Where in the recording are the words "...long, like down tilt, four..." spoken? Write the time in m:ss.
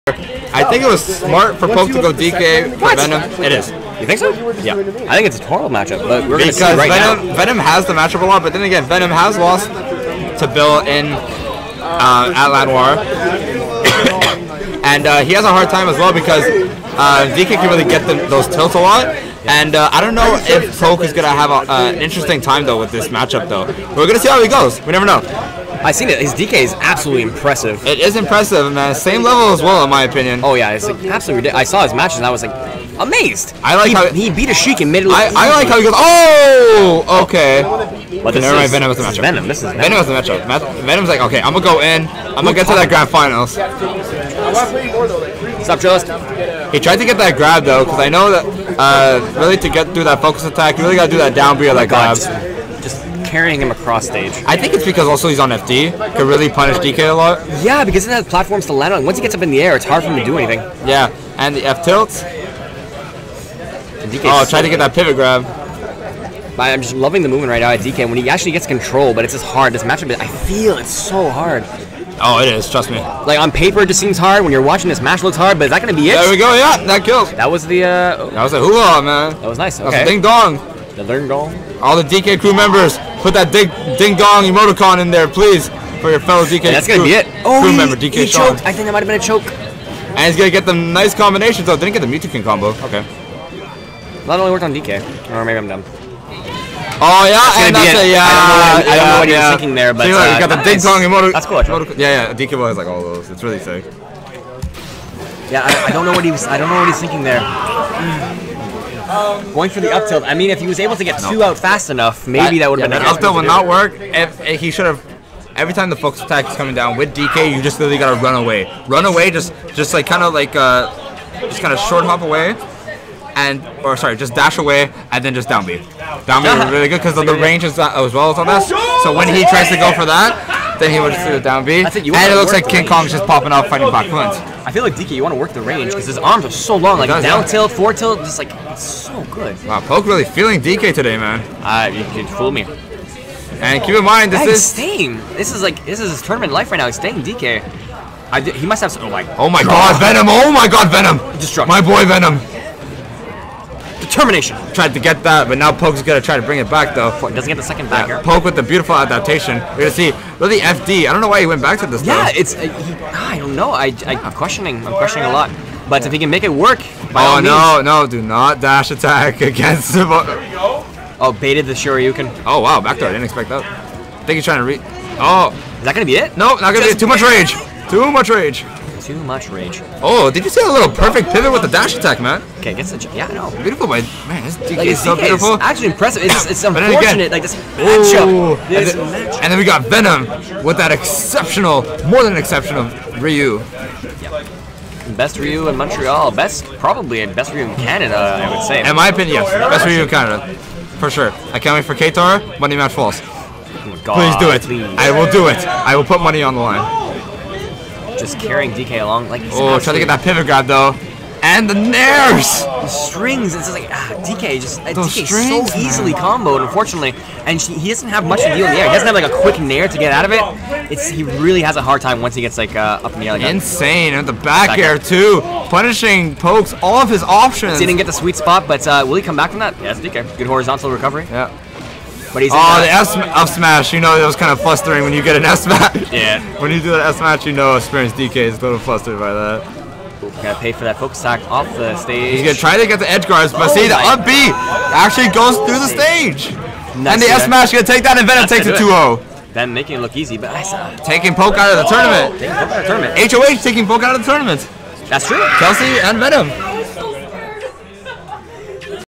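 2:16.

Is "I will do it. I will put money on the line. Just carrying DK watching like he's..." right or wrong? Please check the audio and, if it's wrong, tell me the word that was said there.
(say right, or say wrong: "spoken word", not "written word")
wrong: "along", not "watching".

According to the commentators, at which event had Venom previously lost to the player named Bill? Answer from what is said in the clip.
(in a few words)
Lanoir.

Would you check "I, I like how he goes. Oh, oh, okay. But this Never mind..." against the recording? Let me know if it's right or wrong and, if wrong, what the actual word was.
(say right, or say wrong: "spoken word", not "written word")
right.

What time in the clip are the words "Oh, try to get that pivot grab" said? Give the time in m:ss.
1:04.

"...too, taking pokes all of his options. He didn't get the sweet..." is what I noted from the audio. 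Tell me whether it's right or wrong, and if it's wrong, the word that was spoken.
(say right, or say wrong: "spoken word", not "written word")
wrong: "punishing", not "taking".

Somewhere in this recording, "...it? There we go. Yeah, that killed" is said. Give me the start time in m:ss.
1:16.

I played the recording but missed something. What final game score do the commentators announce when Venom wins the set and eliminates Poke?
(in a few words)
2-0.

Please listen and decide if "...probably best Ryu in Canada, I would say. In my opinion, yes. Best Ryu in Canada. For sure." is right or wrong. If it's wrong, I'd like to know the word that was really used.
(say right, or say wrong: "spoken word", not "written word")
right.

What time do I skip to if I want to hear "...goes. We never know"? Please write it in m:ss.
0:24.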